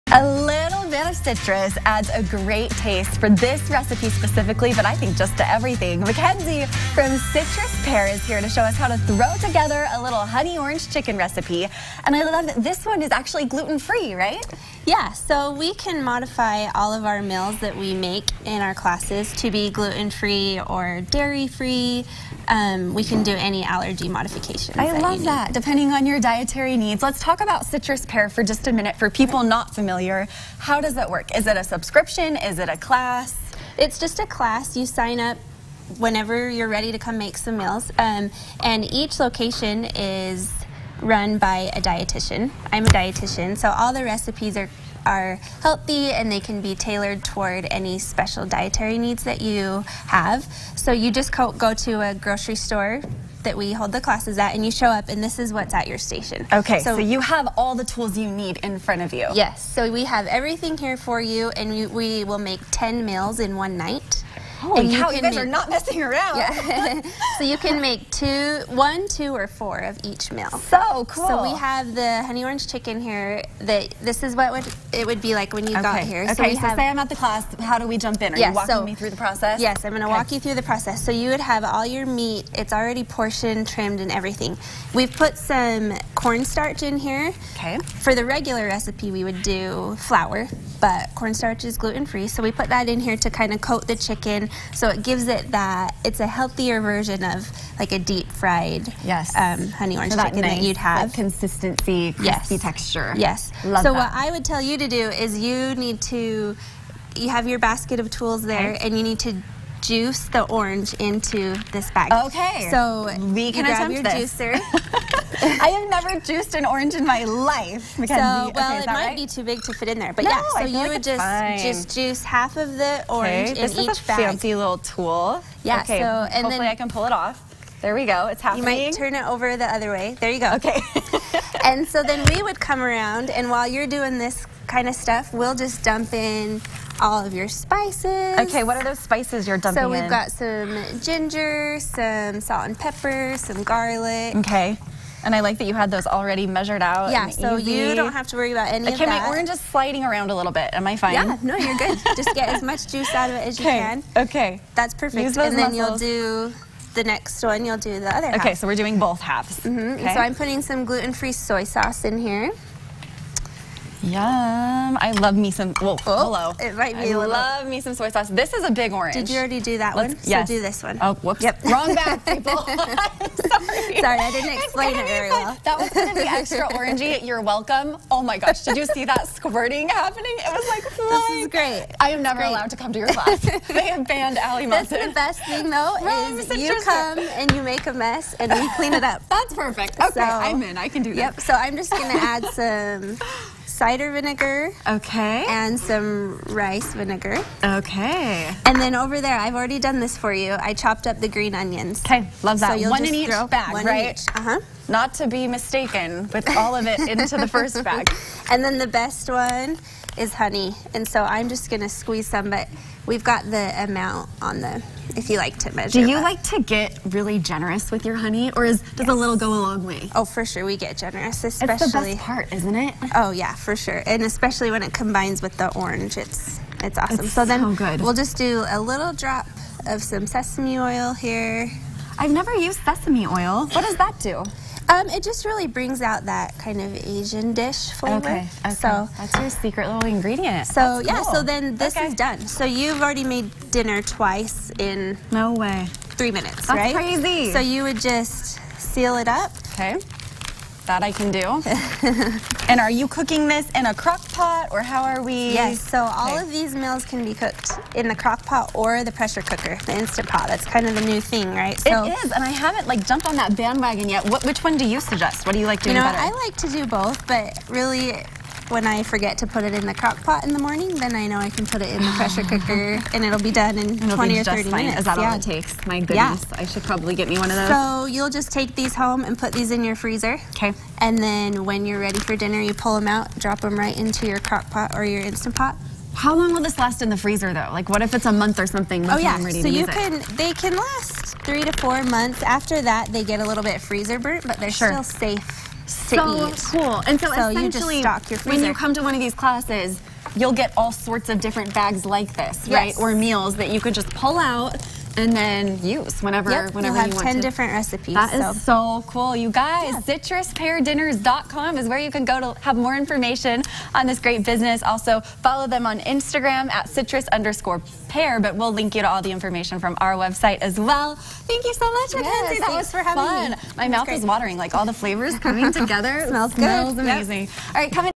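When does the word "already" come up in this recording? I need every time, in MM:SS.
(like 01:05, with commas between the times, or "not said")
01:22, 02:26, 02:49, 03:19, 04:03.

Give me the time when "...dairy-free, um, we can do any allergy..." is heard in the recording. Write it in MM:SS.
00:21.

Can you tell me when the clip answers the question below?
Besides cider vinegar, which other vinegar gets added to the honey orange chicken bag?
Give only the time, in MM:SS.
03:16.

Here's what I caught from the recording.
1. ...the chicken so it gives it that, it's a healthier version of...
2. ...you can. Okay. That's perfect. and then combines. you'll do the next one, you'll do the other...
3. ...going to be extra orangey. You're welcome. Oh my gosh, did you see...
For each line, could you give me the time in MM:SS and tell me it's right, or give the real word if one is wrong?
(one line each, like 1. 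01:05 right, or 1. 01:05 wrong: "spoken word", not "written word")
1. 01:33 right
2. 02:33 wrong: "muscles", not "combines"
3. 02:55 right.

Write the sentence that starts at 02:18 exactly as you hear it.
Okay, what are those spices you're dumping in?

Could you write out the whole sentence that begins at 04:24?
What, which one do you suggest?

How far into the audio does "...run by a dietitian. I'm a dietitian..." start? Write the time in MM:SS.
00:41.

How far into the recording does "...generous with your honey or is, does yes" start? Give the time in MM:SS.
03:37.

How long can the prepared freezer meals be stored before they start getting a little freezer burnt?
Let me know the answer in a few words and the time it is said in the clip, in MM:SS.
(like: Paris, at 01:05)
3 to 4 months, at 04:51.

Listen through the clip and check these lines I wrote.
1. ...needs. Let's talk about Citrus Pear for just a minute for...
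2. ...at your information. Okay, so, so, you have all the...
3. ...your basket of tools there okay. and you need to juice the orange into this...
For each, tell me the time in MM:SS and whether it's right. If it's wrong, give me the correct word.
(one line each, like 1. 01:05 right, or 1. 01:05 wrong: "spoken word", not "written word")
1. 00:26 right
2. 00:55 wrong: "station", not "information"
3. 01:47 right.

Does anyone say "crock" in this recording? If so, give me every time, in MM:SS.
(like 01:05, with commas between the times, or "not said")
04:13, 04:18, 04:29, 04:44.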